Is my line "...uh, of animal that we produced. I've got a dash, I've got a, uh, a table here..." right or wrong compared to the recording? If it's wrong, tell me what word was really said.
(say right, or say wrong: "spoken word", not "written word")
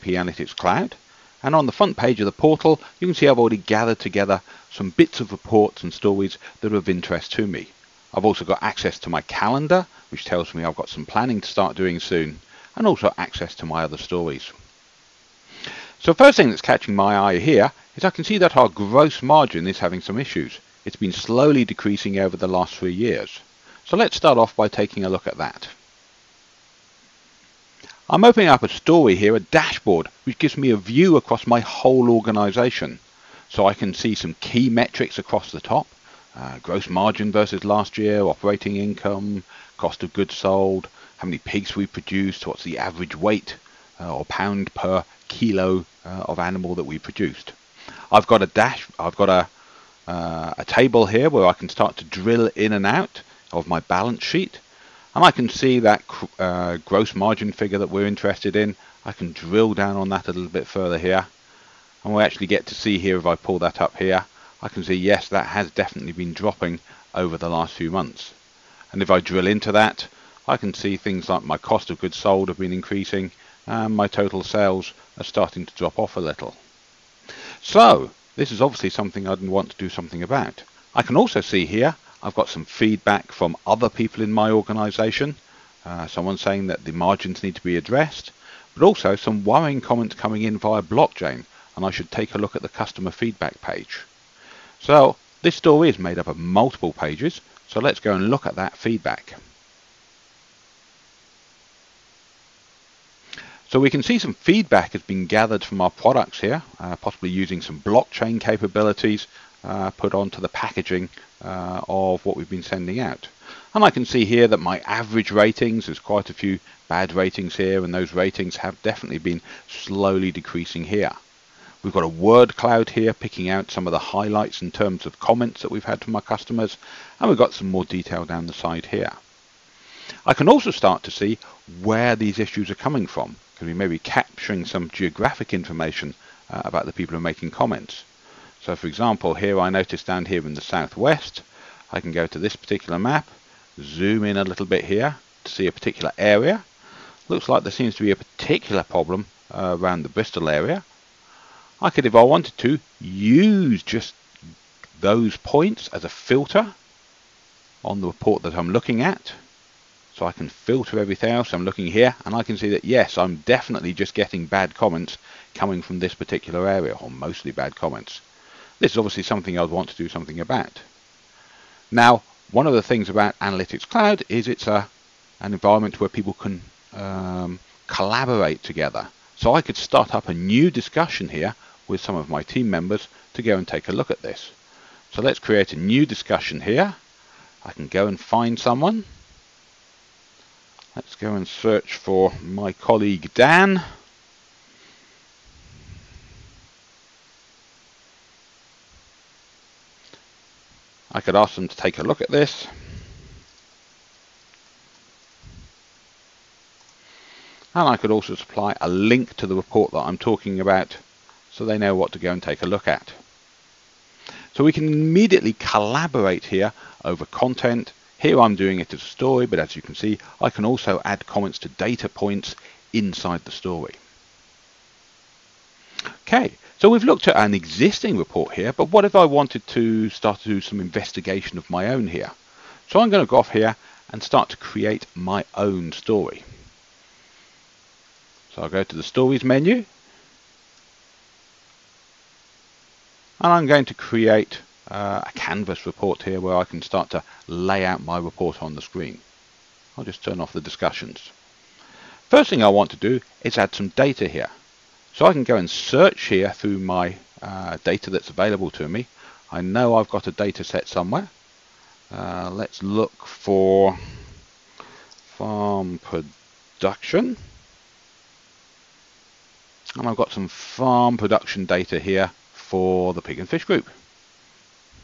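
right.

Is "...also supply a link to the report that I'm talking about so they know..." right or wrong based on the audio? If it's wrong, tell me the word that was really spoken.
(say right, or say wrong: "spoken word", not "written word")
right.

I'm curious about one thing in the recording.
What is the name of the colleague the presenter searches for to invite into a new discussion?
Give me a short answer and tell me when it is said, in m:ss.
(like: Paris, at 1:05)
Dan, at 3:13.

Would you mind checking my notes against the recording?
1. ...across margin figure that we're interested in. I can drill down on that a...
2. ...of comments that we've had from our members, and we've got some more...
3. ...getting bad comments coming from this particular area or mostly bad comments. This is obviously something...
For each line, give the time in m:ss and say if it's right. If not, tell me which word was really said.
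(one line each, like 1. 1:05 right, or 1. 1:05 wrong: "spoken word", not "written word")
1. 0:56 wrong: "gross", not "across"
2. 2:05 wrong: "customers", not "members"
3. 2:44 right.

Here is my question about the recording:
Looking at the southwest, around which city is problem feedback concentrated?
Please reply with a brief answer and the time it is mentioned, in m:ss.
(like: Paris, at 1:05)
Bristol, at 2:30.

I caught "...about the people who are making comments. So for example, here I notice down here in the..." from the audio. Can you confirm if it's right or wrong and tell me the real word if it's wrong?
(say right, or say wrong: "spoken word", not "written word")
right.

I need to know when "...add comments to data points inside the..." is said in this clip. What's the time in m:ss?
3:41.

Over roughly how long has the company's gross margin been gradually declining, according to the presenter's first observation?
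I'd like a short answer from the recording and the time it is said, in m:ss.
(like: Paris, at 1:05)
3 years, at 0:22.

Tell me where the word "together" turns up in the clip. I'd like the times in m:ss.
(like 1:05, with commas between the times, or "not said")
0:03, 2:58.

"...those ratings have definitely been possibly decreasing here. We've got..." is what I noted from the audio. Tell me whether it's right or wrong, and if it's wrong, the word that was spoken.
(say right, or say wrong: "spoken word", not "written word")
wrong: "slowly", not "possibly".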